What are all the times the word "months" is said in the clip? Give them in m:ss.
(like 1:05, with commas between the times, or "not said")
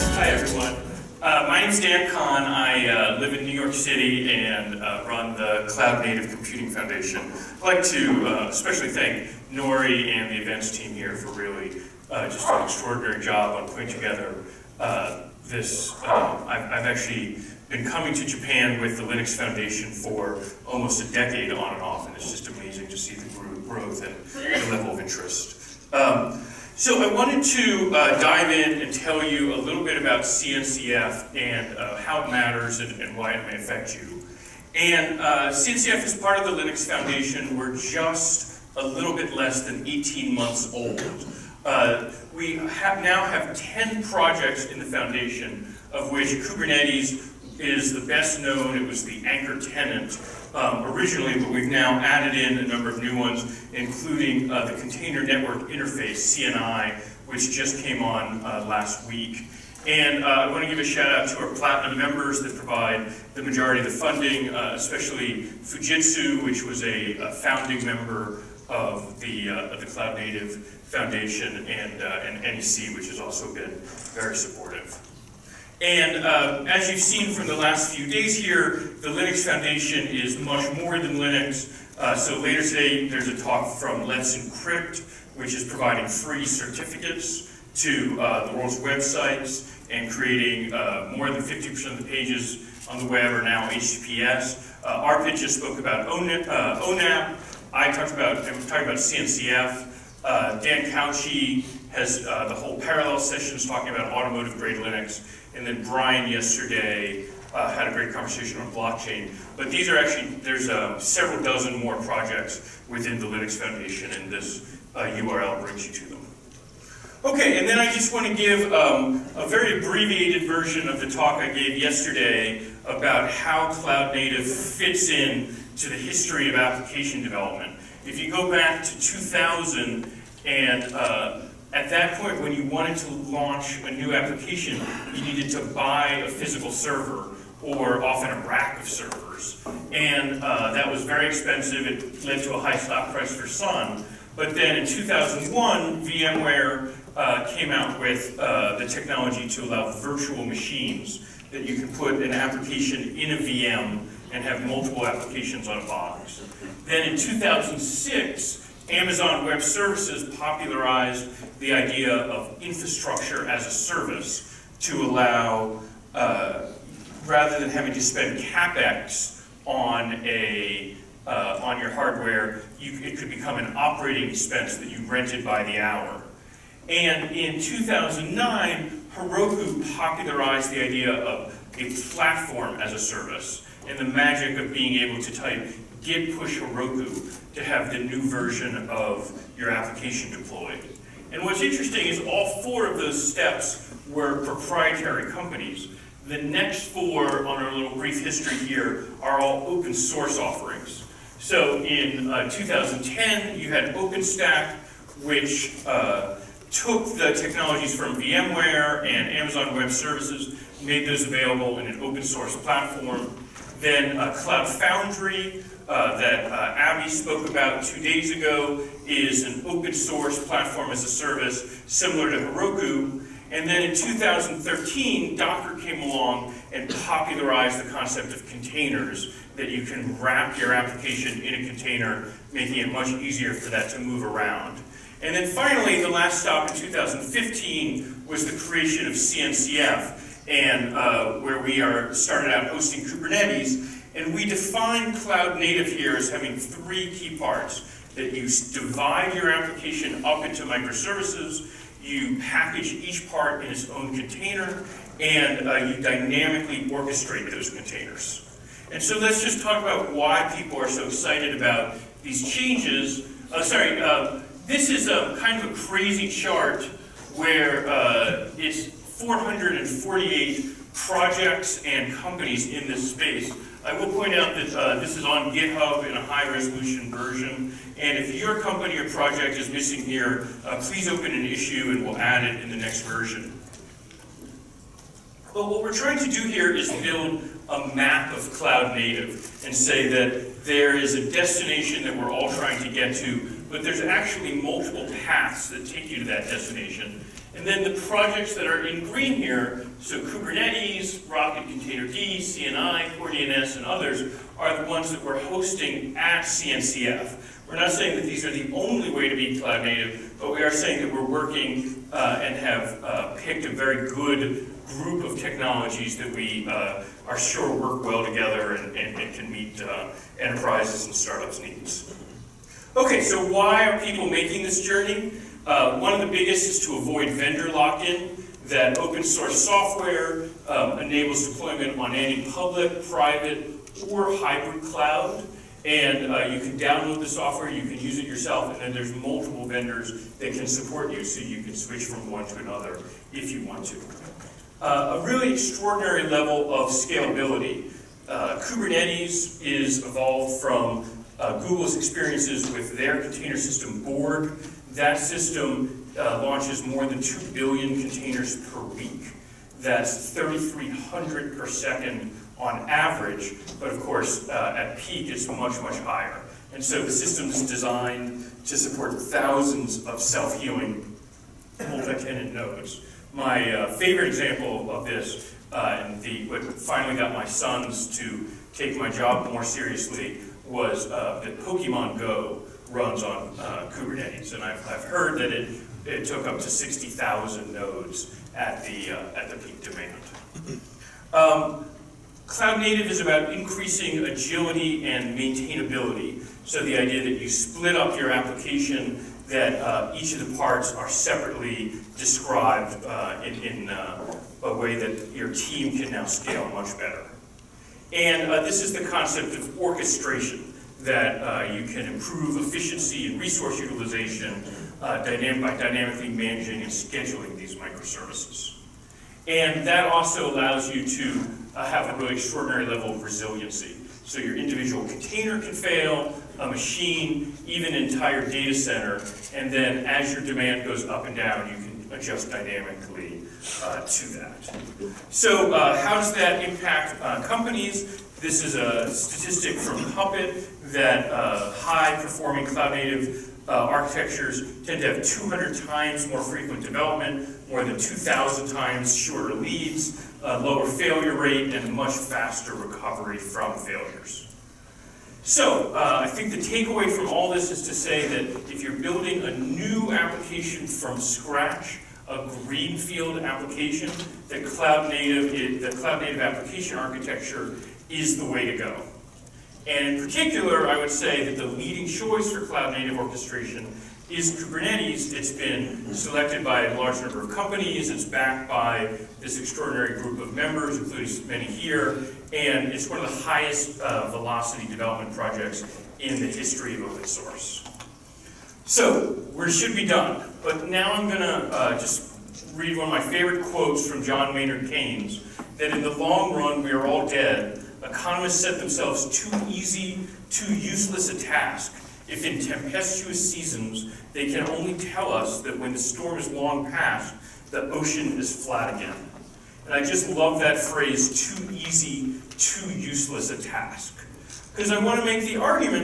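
0:40.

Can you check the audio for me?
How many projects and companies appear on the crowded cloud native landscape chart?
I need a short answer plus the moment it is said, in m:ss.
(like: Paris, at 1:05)
448, at 4:29.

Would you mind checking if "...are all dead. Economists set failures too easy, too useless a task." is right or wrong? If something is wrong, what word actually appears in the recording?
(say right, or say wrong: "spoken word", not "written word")
wrong: "themselves", not "failures".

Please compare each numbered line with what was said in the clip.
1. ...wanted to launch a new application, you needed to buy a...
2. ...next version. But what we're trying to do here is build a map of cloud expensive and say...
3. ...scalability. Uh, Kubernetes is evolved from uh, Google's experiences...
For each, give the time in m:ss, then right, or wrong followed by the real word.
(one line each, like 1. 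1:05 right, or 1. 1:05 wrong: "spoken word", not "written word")
1. 2:12 right
2. 4:42 wrong: "native", not "expensive"
3. 5:46 right.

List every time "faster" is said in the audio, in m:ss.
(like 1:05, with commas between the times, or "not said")
7:32.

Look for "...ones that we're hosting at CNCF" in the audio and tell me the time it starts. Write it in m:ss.
5:04.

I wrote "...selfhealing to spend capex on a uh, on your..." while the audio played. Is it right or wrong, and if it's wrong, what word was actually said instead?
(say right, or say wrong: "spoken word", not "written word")
wrong: "having", not "selfhealing".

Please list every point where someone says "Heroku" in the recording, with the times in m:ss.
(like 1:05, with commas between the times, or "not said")
2:59, 3:06, 3:42.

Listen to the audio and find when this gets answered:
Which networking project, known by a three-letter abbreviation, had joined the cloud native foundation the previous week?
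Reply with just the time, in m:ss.
0:54.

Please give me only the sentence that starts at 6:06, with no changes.
And so the system is designed to support thousands of self-healing multi-tenant nodes.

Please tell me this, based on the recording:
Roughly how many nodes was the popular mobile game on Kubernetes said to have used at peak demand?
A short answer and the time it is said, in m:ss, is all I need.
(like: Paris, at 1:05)
60,000, at 6:26.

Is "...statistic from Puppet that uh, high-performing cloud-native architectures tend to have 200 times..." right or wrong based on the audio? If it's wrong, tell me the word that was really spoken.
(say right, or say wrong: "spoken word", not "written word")
right.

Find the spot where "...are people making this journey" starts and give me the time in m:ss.
5:23.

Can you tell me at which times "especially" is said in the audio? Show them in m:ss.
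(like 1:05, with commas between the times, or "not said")
0:08, 1:04.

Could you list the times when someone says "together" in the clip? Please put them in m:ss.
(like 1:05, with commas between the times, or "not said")
0:13, 5:18.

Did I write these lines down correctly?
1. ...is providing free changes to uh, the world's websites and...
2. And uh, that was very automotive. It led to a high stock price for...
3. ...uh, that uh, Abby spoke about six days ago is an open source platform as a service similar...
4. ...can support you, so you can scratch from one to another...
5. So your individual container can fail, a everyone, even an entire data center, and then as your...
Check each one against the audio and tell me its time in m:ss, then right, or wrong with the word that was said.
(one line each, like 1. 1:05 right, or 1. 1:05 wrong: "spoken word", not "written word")
1. 1:25 wrong: "certificates", not "changes"
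2. 2:19 wrong: "expensive", not "automotive"
3. 3:35 wrong: "two", not "six"
4. 5:40 wrong: "switch", not "scratch"
5. 7:04 wrong: "machine", not "everyone".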